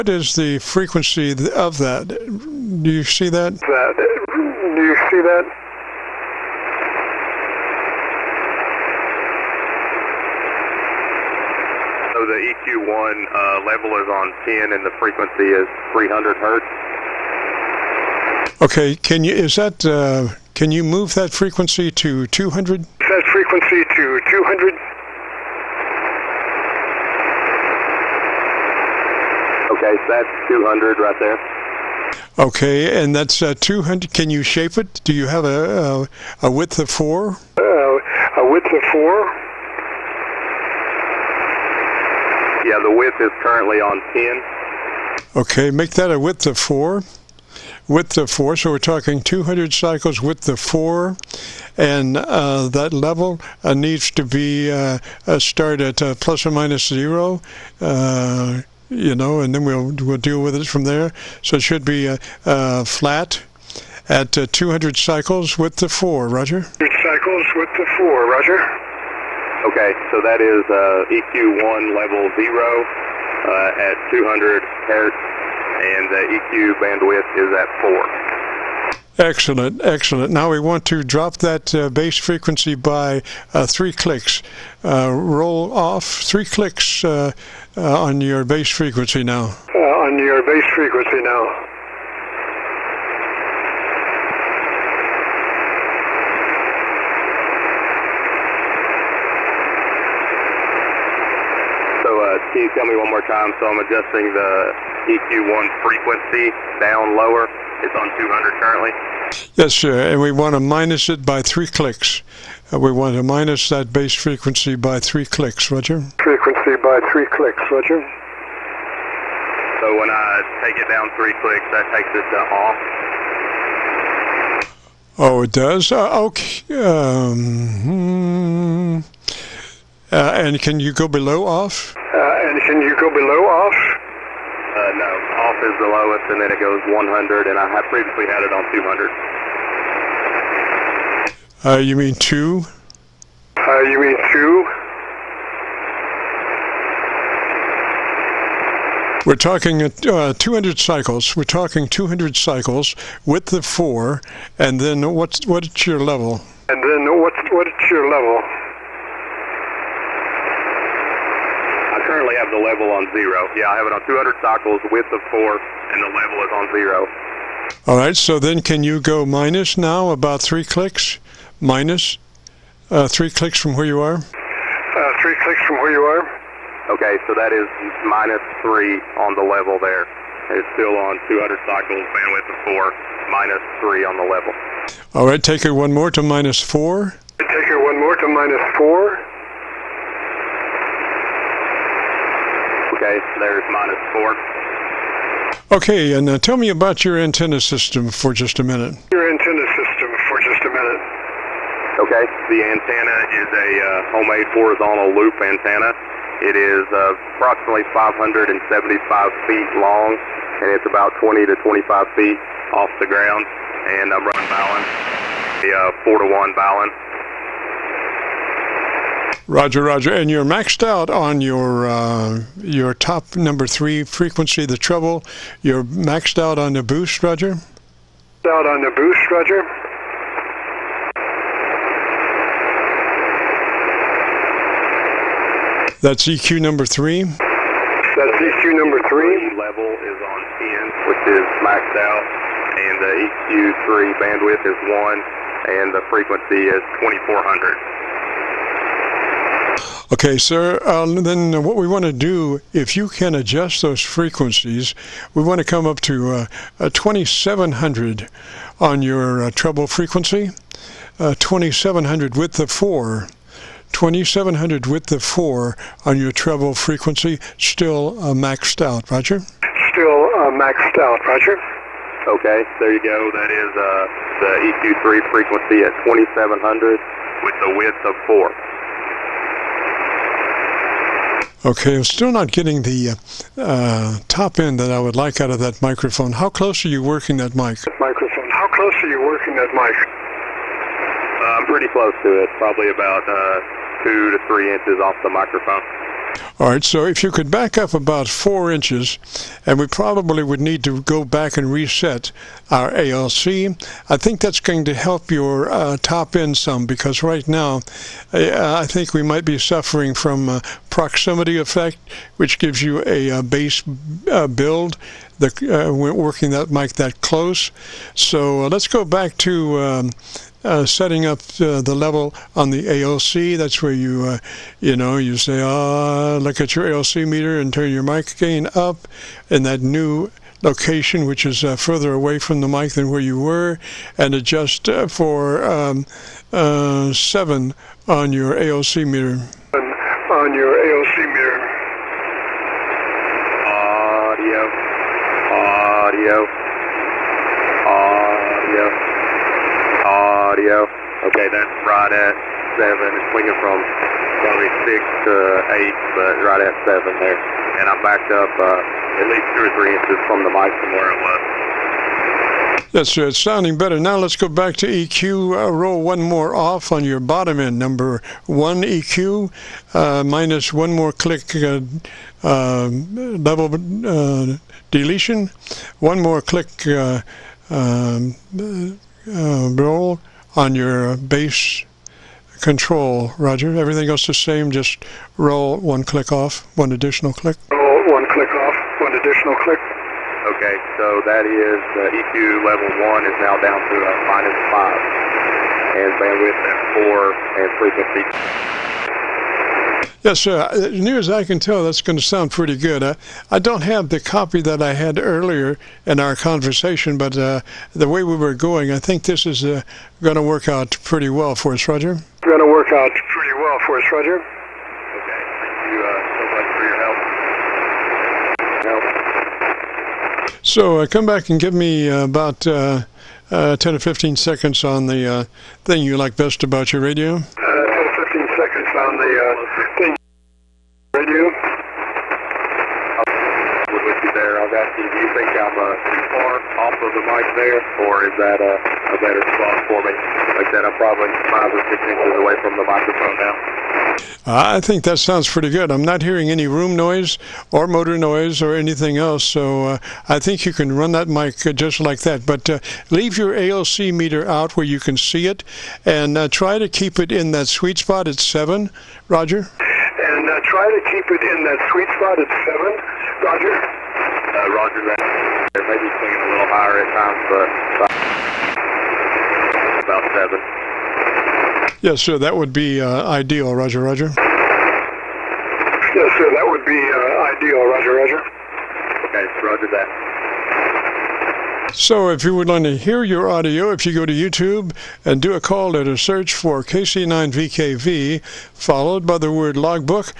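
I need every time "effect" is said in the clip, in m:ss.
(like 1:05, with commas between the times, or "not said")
5:11.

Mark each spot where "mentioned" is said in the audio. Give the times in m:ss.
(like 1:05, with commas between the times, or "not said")
2:12.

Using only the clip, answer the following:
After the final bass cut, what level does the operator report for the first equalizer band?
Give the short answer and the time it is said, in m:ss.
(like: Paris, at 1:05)
minus 5, at 6:34.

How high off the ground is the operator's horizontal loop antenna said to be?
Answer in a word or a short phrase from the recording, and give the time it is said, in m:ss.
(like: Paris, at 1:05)
20 to 25 feet, at 3:31.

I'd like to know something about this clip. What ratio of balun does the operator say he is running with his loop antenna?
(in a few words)
4 to 1.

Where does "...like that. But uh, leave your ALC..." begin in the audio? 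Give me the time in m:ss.
7:31.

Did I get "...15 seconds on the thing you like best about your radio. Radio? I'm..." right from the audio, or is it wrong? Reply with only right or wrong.
right.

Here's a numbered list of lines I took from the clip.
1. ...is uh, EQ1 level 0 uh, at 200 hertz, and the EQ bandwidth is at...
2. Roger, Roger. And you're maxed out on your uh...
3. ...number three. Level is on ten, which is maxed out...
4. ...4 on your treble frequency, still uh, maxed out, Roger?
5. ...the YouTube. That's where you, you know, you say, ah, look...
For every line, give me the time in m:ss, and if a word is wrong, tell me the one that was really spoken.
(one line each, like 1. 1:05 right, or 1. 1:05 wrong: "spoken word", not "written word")
1. 1:10 right
2. 3:39 right
3. 3:58 right
4. 4:25 right
5. 5:22 wrong: "ALC", not "YouTube".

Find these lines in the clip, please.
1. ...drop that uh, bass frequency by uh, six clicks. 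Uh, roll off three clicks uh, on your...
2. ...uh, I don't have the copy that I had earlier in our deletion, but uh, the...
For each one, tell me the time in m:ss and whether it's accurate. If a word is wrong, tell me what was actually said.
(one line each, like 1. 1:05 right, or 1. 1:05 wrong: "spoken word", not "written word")
1. 1:21 wrong: "three", not "six"
2. 6:43 wrong: "conversation", not "deletion".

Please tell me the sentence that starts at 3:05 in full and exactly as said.
All right, take her one more to minus four.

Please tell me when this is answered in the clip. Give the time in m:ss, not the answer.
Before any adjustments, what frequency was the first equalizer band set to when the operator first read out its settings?
0:15.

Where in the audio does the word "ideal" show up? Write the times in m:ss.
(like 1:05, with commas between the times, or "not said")
7:53, 7:57.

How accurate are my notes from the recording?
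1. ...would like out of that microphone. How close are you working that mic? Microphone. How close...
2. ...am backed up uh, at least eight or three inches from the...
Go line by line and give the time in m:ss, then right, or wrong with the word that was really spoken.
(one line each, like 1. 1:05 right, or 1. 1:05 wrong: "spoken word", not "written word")
1. 4:44 right
2. 5:57 wrong: "two", not "eight".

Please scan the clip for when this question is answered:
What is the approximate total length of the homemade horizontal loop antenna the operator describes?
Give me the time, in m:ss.
3:27.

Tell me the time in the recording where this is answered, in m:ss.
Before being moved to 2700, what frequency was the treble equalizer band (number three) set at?
4:06.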